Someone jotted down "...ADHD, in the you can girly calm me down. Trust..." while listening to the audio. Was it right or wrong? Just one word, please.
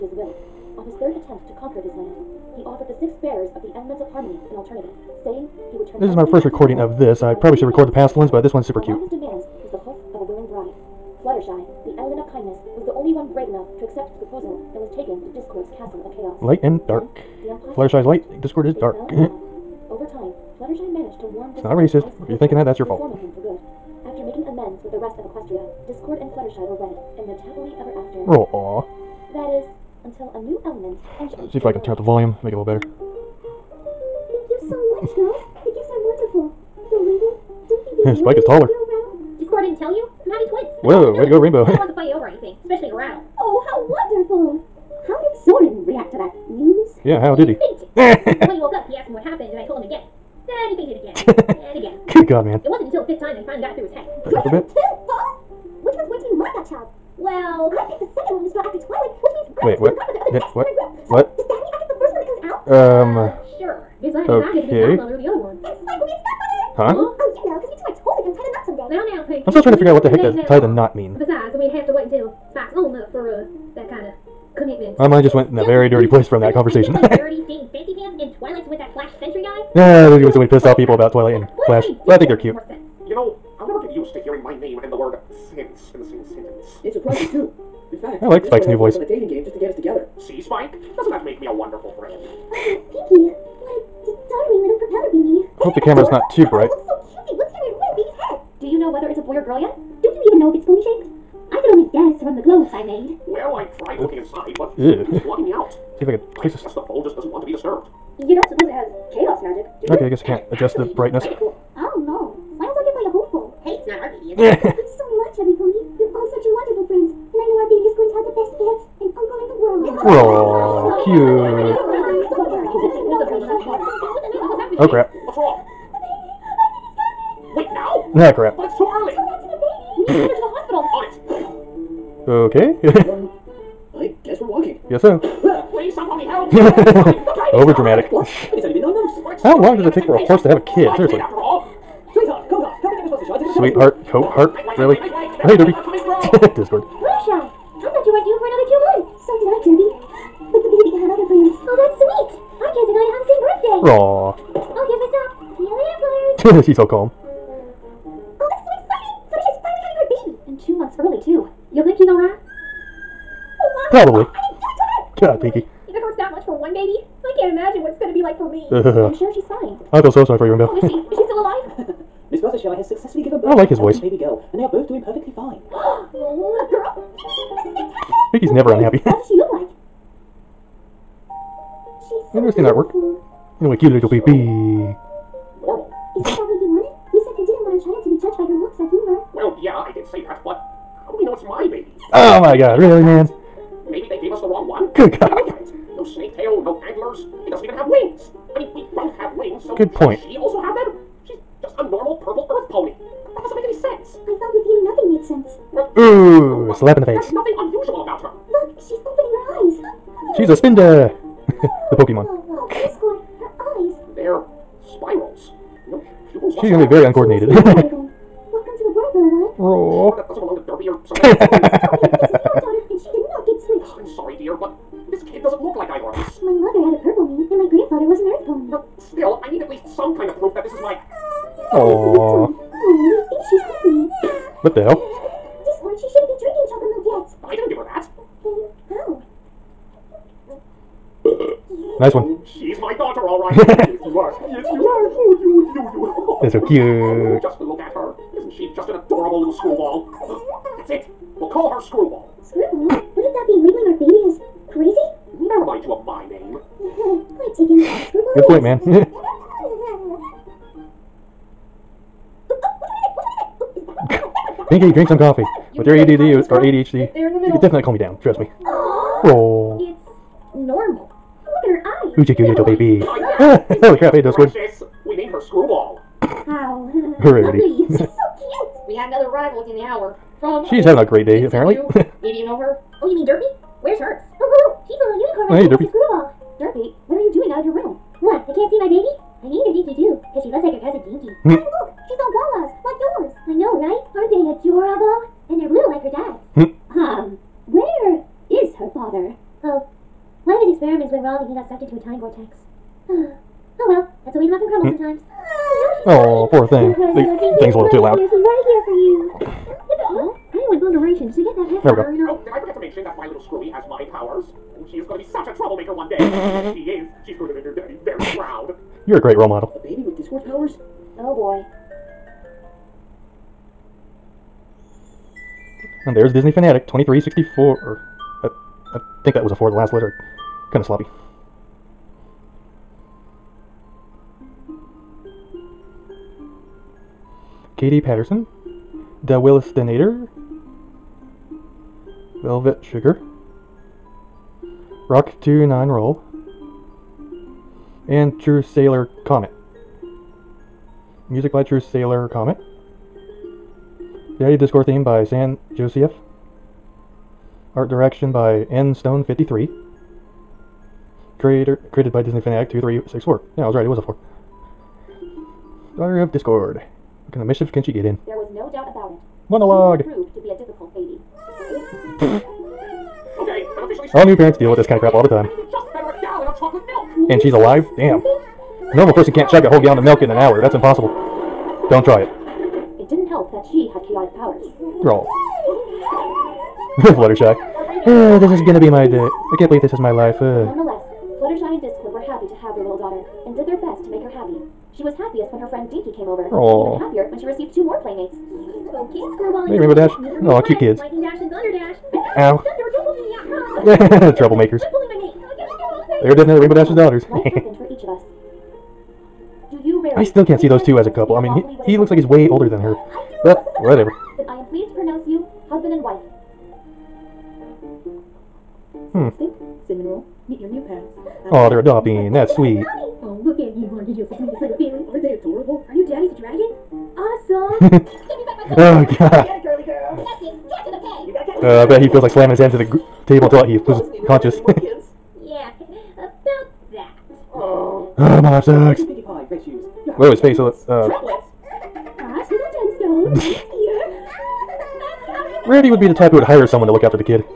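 wrong.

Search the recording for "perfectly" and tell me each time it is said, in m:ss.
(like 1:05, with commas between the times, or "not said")
2:55.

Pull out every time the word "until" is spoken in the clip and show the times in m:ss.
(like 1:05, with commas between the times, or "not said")
0:30, 0:52, 1:12, 7:13.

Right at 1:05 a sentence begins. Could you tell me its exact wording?
And Spike will be its godmother.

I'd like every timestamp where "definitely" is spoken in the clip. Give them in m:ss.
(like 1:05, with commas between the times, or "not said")
4:27, 6:46.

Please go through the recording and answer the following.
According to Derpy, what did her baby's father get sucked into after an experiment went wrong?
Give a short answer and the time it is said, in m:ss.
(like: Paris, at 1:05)
A time vortex, at 5:02.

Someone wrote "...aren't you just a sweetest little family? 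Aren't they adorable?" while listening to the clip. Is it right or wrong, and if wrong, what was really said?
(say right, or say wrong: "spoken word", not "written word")
right.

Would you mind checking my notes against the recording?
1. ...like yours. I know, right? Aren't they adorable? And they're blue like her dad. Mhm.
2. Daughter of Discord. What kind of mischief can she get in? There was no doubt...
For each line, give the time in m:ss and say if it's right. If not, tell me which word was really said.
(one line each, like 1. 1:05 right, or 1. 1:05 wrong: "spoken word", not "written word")
1. 4:52 right
2. 6:05 right.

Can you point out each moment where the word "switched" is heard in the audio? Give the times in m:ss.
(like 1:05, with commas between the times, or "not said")
3:43.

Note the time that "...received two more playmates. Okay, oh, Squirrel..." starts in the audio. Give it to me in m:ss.
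6:37.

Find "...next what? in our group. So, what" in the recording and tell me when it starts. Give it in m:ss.
1:00.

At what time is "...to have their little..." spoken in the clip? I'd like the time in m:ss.
6:32.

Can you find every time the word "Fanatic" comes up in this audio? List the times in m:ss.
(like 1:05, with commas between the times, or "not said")
5:26, 6:02.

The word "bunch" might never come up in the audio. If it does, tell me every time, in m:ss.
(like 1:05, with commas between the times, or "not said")
not said.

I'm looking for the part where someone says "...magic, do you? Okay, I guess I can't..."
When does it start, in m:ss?
1:49.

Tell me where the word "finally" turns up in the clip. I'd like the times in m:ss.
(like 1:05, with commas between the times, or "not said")
0:53, 2:39.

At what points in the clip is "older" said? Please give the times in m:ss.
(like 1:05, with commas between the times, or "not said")
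6:52.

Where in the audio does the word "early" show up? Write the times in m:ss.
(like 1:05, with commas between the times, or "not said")
2:08, 2:40.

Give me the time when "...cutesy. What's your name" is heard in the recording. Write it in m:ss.
1:37.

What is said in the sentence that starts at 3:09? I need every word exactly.
Well, yeah, I did say that, but how do we know it's my baby?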